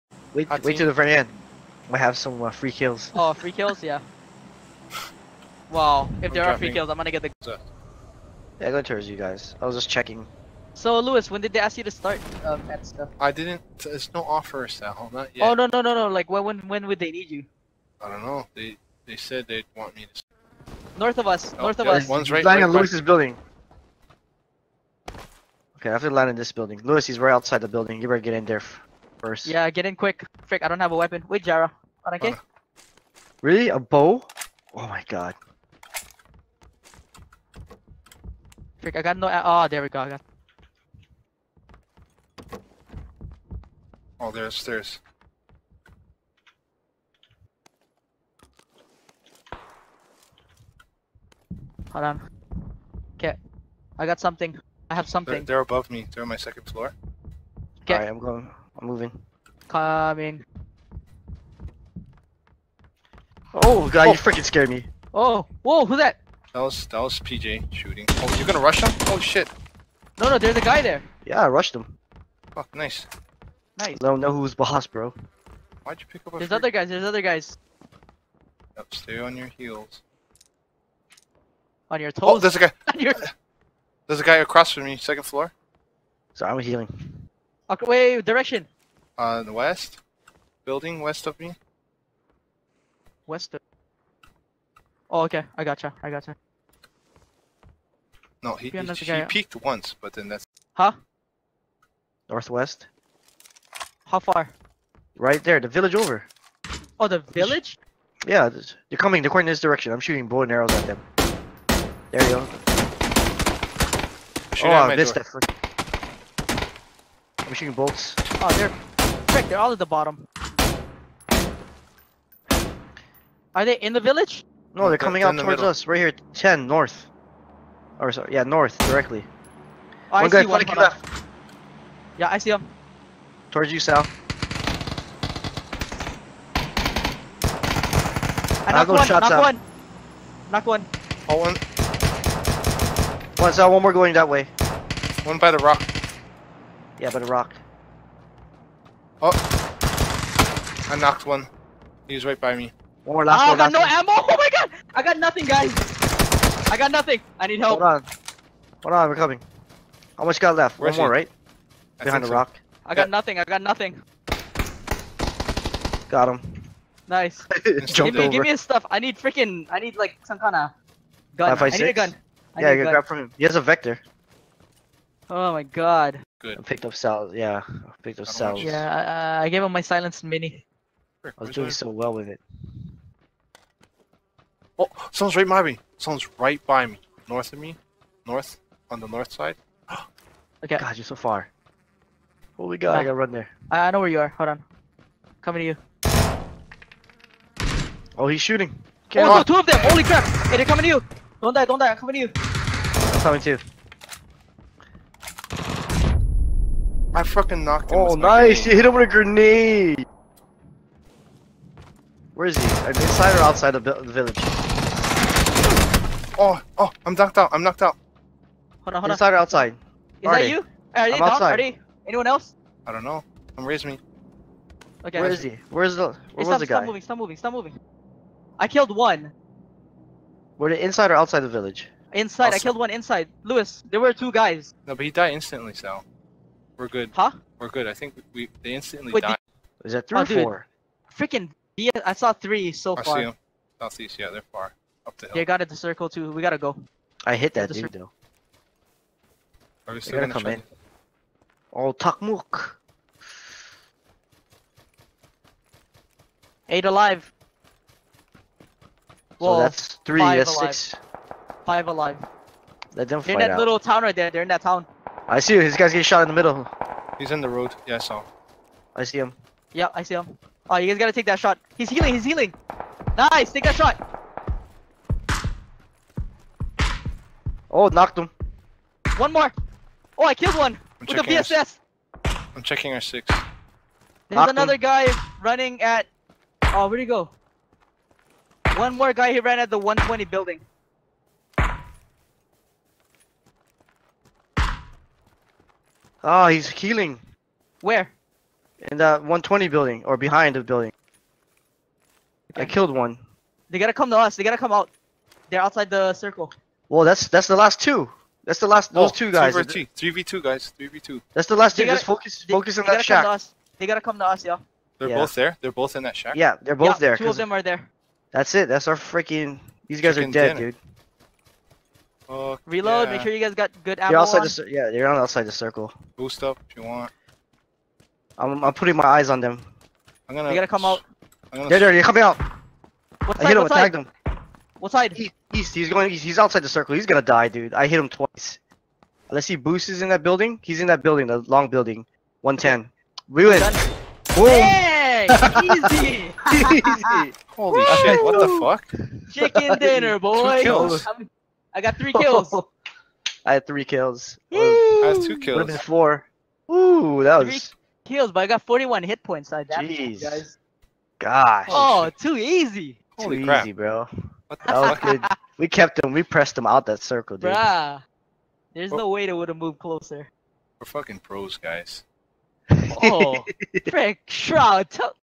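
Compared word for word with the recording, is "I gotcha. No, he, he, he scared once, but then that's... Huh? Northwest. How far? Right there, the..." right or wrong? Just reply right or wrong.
wrong.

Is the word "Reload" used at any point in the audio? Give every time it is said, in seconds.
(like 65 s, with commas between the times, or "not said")
322 s.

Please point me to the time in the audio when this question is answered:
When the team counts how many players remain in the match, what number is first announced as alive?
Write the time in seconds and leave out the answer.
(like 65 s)
256 s.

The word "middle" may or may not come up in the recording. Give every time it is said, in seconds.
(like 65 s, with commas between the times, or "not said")
125 s, 266 s.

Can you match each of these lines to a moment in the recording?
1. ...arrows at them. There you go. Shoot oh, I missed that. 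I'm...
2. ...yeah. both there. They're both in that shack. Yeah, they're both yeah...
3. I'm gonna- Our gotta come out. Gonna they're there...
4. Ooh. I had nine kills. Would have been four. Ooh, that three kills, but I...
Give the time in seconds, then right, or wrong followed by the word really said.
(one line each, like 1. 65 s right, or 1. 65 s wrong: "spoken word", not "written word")
1. 110 s right
2. 315 s right
3. 330 s wrong: "You", not "Our"
4. 354 s wrong: "two", not "nine".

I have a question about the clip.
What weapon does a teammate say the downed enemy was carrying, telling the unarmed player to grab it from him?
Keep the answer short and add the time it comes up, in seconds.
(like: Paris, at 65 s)
Vector, at 173 s.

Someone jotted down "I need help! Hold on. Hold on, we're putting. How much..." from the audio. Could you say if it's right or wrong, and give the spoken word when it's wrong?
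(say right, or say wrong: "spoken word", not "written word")
wrong: "coming", not "putting".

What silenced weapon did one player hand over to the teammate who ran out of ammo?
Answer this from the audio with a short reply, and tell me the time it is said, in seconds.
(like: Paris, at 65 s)
Silenced mini, at 179 s.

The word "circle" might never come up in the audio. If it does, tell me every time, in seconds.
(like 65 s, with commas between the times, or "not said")
245 s, 306 s, 325 s, 336 s, 367 s.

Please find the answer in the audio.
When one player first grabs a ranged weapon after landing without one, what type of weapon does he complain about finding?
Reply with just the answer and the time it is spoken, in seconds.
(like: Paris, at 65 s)
A bow, at 33 s.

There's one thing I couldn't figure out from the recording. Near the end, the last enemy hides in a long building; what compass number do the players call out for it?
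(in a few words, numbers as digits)
110.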